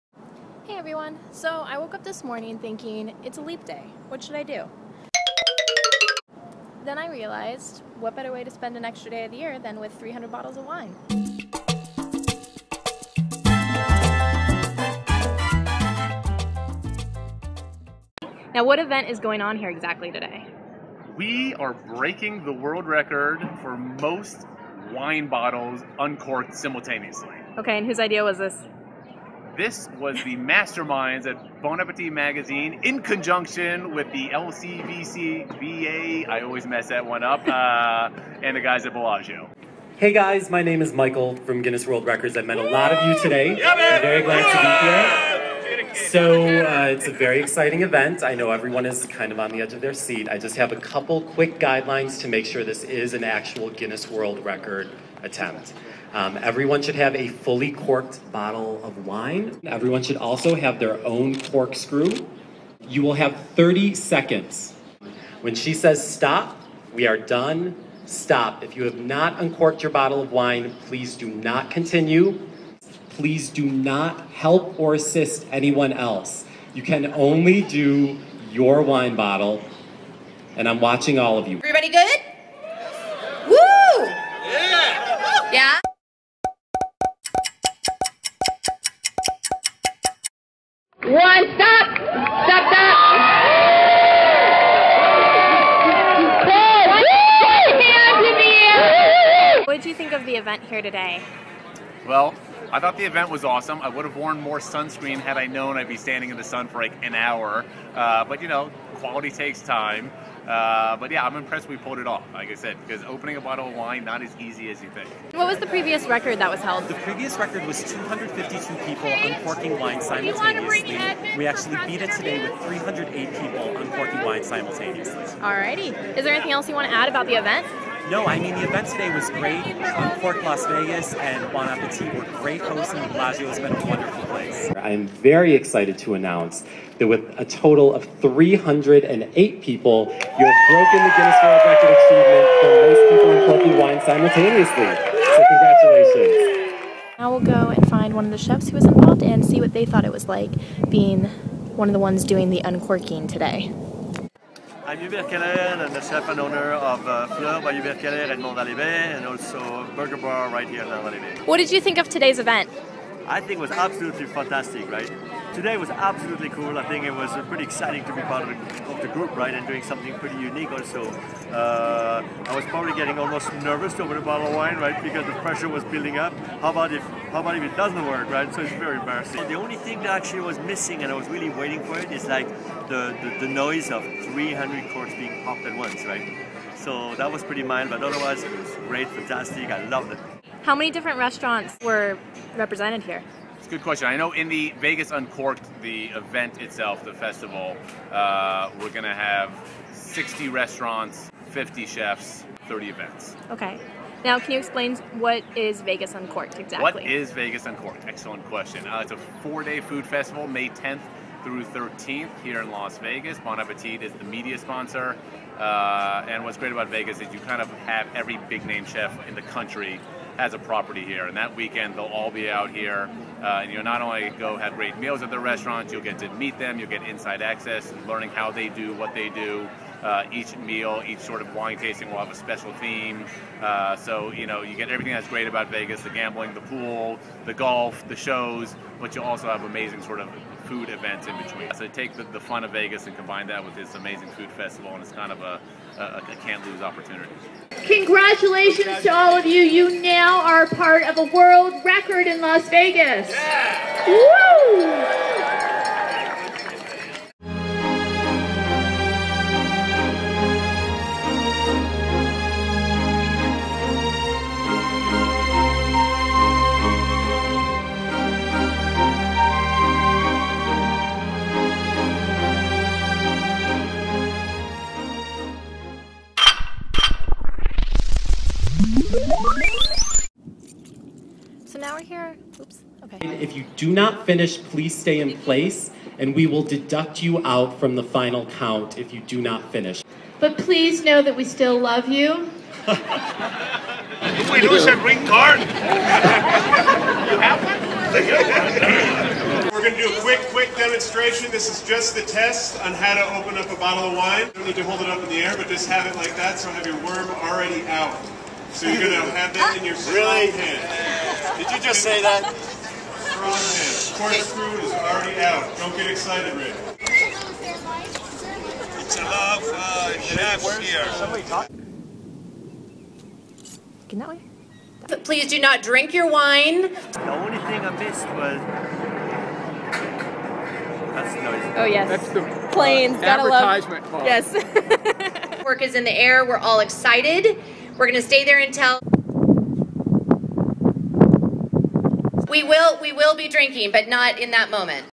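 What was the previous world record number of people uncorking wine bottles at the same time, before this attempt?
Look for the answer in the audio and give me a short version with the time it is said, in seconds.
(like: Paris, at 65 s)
252, at 117 s.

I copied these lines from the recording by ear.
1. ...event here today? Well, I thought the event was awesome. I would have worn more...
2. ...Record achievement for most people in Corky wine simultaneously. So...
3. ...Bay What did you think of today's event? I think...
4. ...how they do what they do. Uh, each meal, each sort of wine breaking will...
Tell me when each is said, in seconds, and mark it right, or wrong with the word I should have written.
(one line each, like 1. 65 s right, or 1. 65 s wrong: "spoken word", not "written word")
1. 100 s right
2. 141 s right
3. 161 s right
4. 228 s wrong: "tasting", not "breaking".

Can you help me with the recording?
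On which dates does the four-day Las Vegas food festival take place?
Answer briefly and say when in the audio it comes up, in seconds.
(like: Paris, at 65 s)
May 10th through 13th, at 210 s.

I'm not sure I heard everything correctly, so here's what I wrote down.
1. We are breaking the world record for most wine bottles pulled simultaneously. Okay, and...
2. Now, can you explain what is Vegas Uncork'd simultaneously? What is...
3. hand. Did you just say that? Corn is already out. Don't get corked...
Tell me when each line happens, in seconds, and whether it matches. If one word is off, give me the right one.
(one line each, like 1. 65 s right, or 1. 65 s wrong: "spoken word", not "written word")
1. 21 s wrong: "uncorked", not "pulled"
2. 204 s wrong: "exactly", not "simultaneously"
3. 310 s wrong: "excited", not "corked".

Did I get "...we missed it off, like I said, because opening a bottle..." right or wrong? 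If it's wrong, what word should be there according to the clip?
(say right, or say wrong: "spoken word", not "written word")
wrong: "pulled", not "missed".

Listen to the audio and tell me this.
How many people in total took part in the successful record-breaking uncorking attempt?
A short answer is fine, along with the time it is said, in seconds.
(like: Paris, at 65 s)
308, at 122 s.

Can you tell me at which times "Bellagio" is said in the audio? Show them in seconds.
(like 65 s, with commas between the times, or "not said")
38 s, 133 s.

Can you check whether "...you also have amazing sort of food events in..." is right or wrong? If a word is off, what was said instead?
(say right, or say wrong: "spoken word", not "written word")
right.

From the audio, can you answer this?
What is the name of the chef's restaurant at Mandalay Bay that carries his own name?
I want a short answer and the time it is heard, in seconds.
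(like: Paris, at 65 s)
Fleur, at 157 s.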